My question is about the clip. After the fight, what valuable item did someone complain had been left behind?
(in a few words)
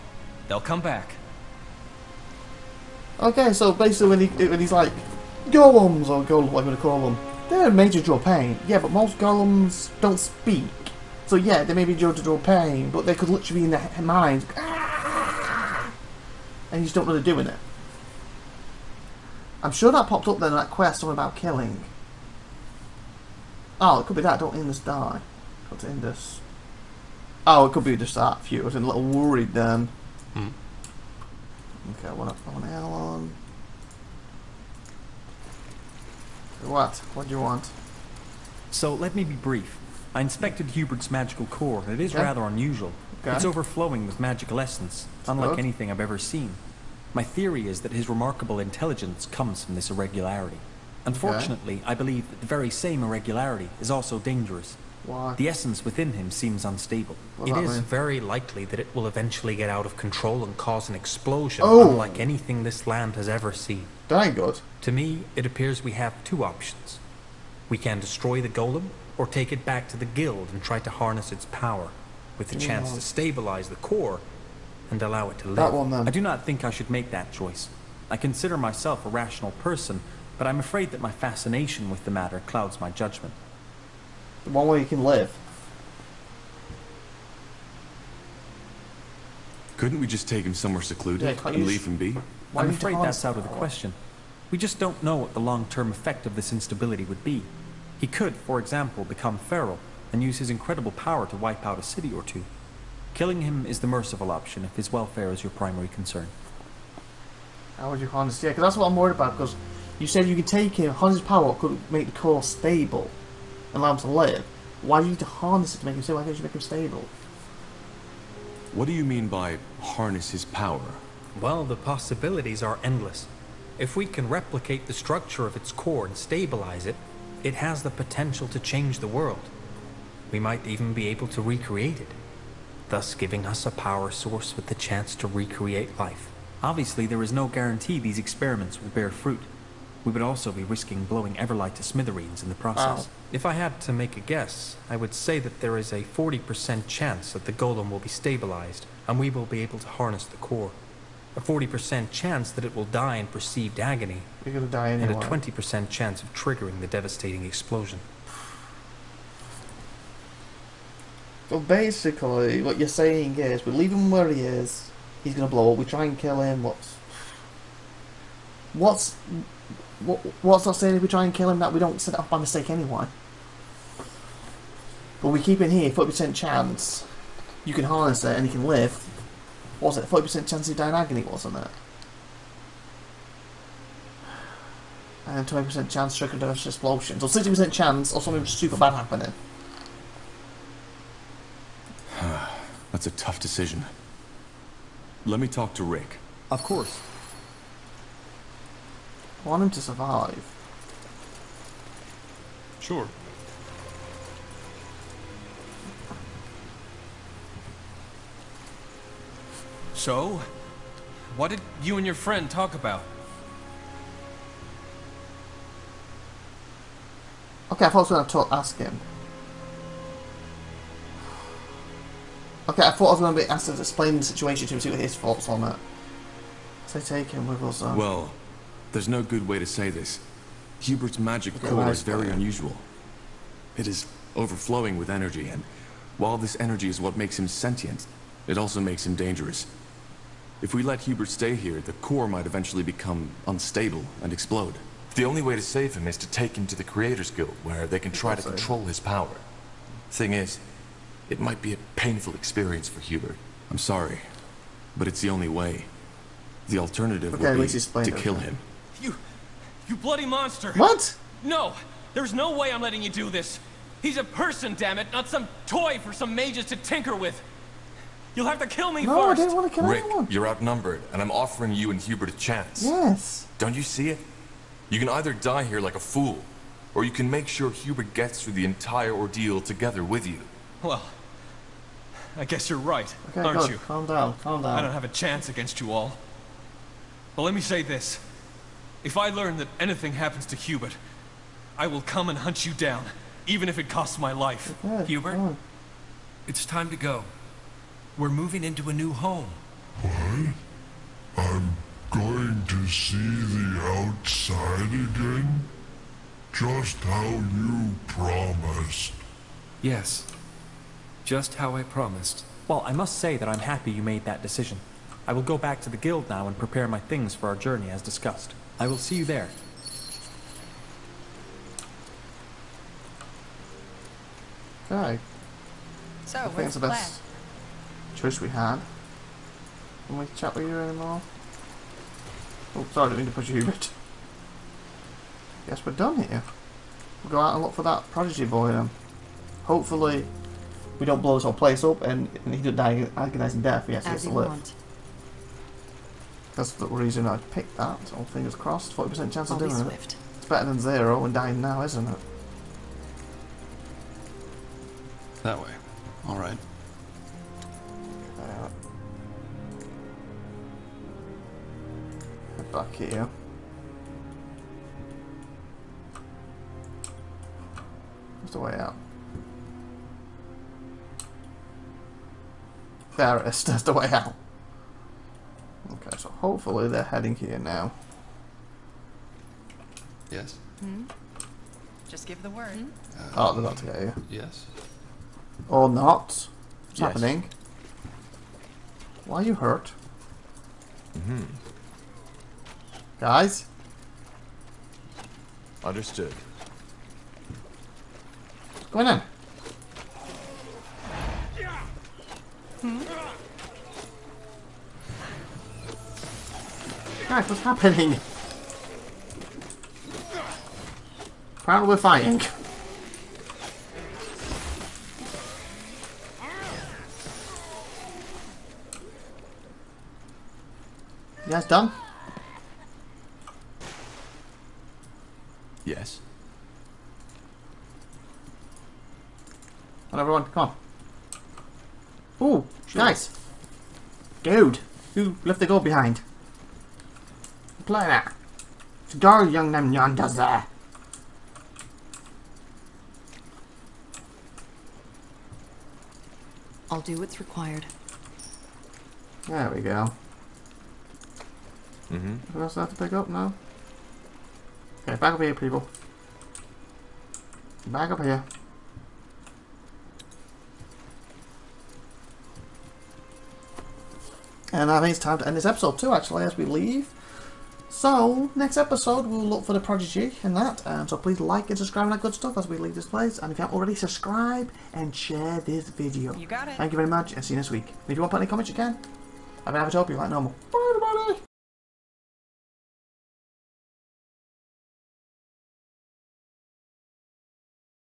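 gold.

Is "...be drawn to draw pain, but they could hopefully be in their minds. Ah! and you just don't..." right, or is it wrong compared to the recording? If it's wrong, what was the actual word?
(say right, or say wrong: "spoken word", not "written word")
wrong: "literally", not "hopefully".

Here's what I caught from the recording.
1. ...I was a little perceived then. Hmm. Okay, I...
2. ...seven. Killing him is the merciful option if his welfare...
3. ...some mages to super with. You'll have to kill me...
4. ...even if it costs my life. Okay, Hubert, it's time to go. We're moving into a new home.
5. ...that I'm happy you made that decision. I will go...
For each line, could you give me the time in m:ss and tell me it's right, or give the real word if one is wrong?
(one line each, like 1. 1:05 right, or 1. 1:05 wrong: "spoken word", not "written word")
1. 0:28 wrong: "worried", not "perceived"
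2. 1:42 wrong: "two", not "seven"
3. 4:26 wrong: "tinker", not "super"
4. 4:53 right
5. 5:13 right.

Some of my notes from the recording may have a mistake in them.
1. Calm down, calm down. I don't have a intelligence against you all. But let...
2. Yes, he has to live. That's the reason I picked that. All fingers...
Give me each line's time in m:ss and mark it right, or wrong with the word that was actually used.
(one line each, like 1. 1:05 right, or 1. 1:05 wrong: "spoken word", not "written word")
1. 4:43 wrong: "chance", not "intelligence"
2. 5:43 right.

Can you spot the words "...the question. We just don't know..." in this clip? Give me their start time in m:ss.
1:33.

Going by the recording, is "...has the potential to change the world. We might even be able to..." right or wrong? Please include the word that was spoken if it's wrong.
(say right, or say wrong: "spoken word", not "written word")
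right.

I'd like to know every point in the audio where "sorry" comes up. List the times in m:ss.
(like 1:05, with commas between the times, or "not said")
4:13, 5:32.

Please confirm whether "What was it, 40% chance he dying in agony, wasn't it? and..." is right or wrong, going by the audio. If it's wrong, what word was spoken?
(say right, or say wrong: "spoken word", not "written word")
right.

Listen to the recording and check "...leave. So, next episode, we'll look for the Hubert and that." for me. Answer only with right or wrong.
wrong.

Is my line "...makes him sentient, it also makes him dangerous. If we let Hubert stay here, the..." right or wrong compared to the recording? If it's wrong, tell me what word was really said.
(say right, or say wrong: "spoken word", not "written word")
right.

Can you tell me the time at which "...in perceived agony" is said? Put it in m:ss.
2:33.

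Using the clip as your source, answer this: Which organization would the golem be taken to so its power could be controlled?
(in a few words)
Creators Guild.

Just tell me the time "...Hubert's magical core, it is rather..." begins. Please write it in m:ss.
0:40.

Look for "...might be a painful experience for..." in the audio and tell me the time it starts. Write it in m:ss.
4:11.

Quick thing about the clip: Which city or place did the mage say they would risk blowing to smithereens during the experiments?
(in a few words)
Everlight.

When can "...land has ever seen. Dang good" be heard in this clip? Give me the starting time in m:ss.
1:02.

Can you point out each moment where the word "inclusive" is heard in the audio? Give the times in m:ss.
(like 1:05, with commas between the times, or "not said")
not said.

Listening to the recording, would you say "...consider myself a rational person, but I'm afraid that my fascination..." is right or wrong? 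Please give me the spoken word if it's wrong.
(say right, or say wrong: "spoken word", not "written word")
right.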